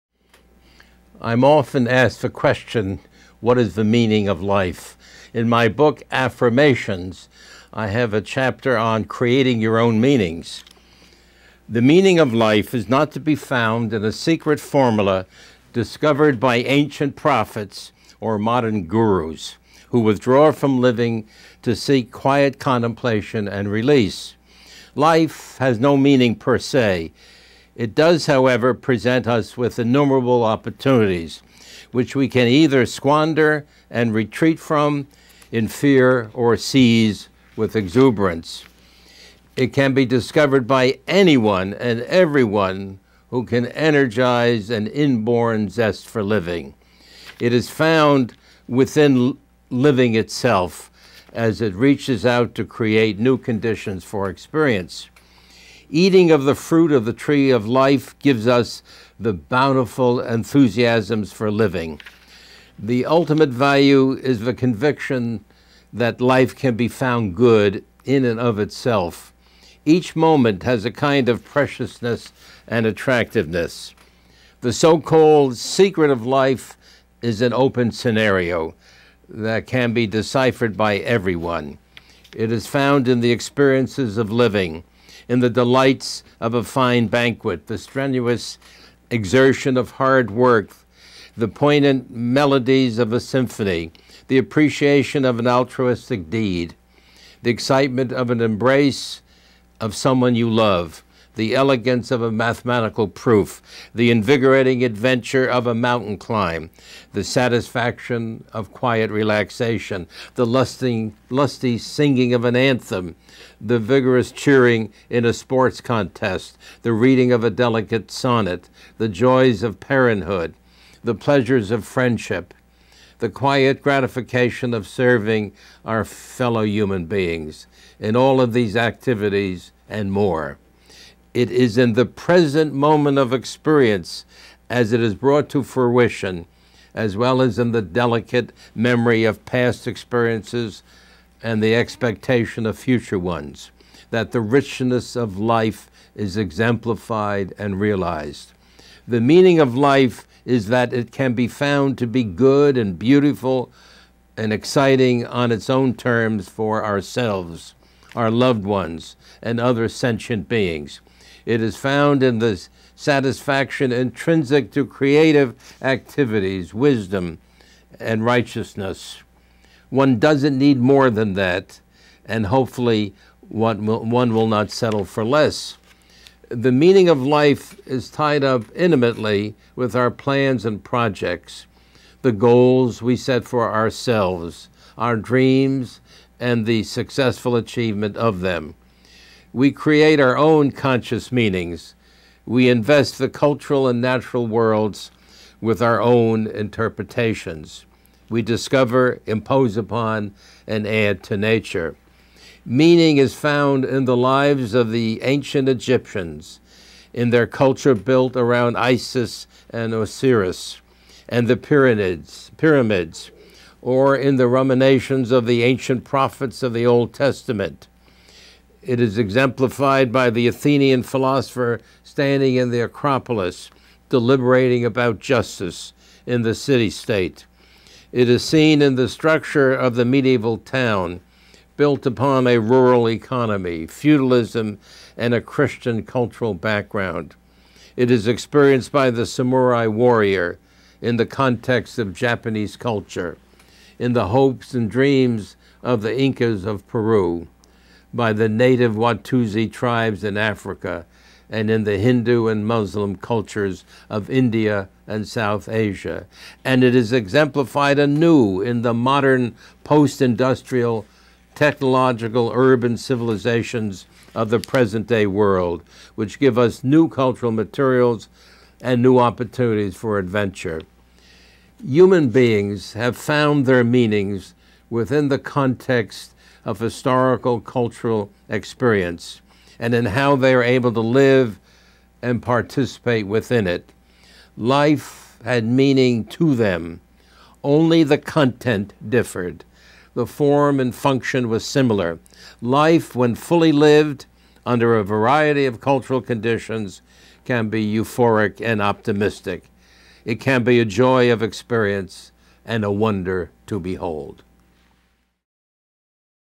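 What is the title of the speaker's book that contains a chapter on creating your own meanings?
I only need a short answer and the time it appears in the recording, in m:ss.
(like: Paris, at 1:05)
Affirmations, at 0:06.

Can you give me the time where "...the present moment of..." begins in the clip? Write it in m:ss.
2:11.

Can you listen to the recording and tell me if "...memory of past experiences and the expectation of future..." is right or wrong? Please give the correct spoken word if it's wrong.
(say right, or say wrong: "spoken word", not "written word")
right.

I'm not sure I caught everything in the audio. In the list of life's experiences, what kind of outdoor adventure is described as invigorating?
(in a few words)
mountain climb.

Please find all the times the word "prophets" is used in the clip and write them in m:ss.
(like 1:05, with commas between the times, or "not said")
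0:17, 3:36.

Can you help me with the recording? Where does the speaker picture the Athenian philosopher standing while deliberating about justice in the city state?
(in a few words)
the Acropolis.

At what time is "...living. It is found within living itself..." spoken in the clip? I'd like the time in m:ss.
0:46.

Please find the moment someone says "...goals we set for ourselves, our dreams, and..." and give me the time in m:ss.
3:02.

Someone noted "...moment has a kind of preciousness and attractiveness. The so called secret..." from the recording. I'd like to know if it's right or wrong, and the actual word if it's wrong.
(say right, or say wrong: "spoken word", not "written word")
right.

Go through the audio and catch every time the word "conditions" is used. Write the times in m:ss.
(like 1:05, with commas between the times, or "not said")
0:53, 4:56.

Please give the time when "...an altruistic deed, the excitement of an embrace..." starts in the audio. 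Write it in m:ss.
1:35.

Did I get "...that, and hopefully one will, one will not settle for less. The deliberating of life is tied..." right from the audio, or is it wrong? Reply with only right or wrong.
wrong.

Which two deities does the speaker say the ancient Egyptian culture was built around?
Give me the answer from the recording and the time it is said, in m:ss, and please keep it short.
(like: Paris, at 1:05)
Isis and Osiris, at 3:28.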